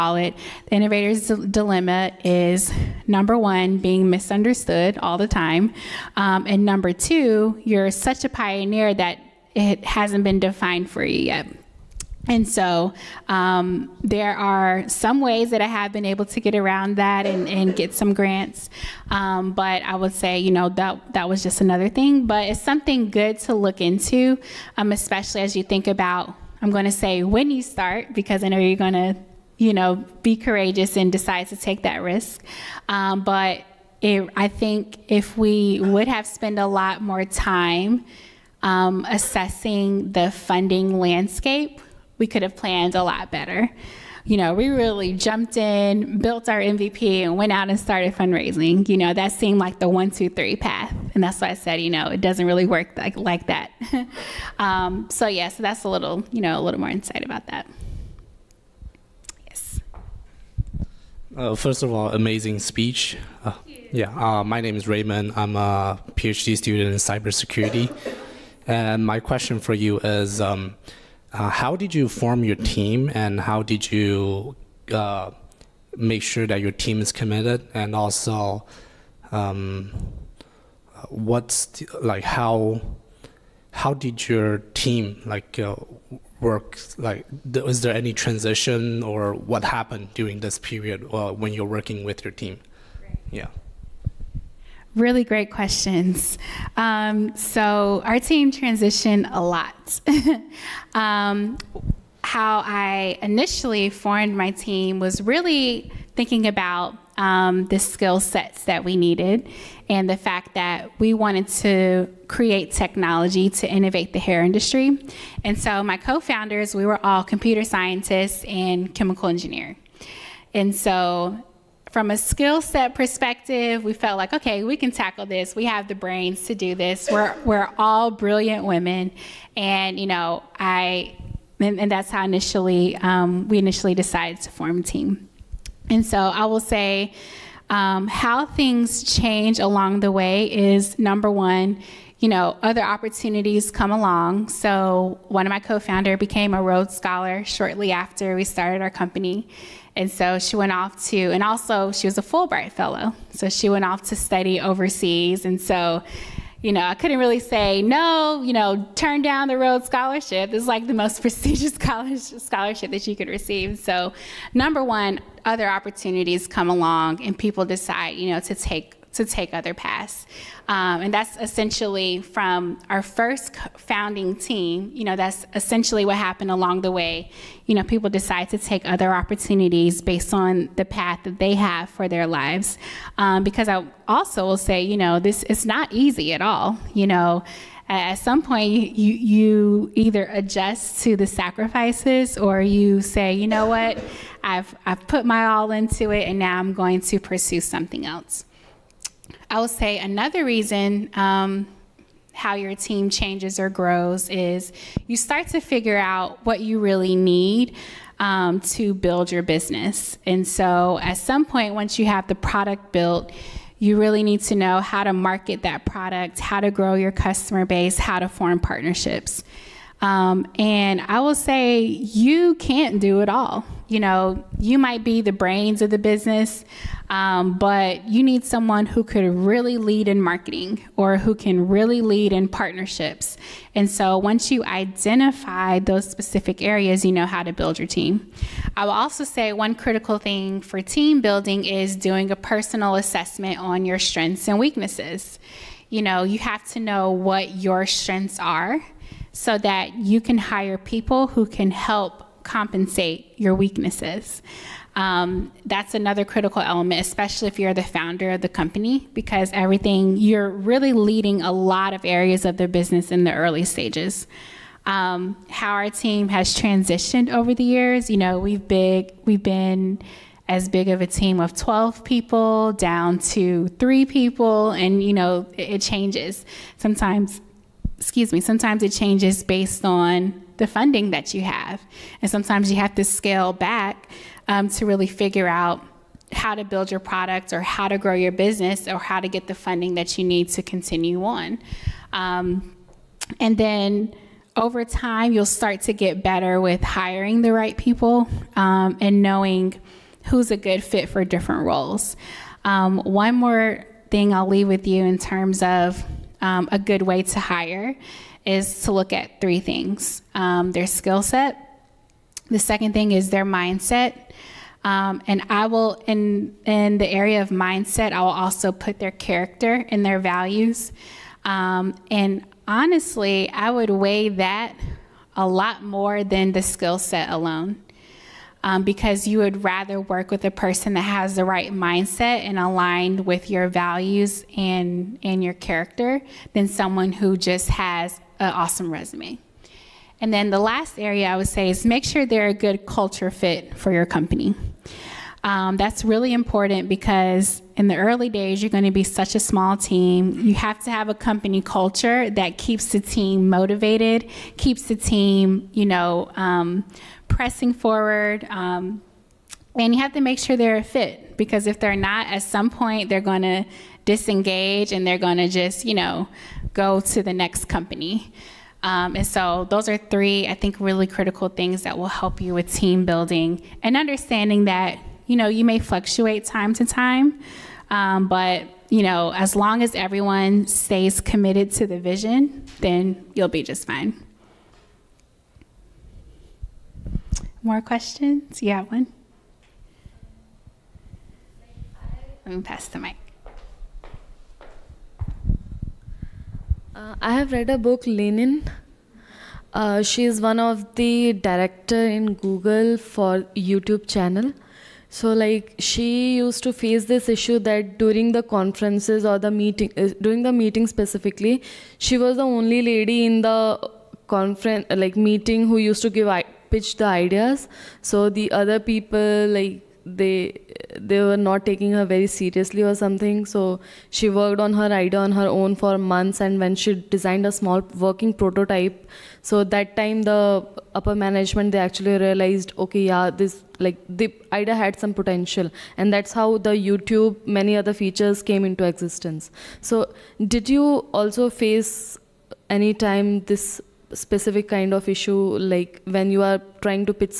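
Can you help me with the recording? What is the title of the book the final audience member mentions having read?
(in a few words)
Lean In.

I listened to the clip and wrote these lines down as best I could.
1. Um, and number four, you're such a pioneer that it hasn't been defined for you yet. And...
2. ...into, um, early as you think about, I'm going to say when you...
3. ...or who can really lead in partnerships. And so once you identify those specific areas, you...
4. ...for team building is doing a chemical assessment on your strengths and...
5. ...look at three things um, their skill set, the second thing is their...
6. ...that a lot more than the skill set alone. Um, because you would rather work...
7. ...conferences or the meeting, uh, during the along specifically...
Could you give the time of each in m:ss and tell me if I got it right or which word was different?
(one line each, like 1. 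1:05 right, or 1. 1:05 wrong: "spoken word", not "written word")
1. 0:06 wrong: "two", not "four"
2. 0:23 wrong: "especially", not "early"
3. 3:50 right
4. 4:00 wrong: "personal", not "chemical"
5. 5:08 right
6. 5:24 right
7. 6:48 wrong: "meeting", not "along".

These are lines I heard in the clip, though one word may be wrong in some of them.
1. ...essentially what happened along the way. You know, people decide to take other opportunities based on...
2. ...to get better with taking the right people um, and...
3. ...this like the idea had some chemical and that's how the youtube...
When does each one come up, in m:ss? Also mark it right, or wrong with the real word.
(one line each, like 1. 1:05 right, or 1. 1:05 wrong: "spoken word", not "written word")
1. 2:55 right
2. 4:55 wrong: "hiring", not "taking"
3. 7:13 wrong: "potential", not "chemical".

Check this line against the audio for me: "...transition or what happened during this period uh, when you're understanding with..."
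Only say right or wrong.
wrong.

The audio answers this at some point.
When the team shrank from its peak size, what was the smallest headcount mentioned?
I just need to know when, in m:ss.
4:33.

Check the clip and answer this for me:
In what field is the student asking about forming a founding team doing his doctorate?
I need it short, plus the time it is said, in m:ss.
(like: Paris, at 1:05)
Cybersecurity, at 1:06.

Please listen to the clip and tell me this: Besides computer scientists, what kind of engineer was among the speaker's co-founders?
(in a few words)
Chemical engineer.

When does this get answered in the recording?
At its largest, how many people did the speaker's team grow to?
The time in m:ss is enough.
4:31.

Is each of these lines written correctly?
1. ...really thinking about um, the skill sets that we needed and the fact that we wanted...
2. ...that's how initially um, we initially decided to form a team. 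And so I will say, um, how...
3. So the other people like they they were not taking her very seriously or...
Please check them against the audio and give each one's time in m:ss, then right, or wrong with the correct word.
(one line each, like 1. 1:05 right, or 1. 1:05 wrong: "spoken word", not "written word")
1. 1:45 right
2. 2:11 right
3. 6:57 right.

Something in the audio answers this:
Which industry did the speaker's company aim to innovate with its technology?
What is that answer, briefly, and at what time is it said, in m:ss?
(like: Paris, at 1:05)
Hair industry, at 1:54.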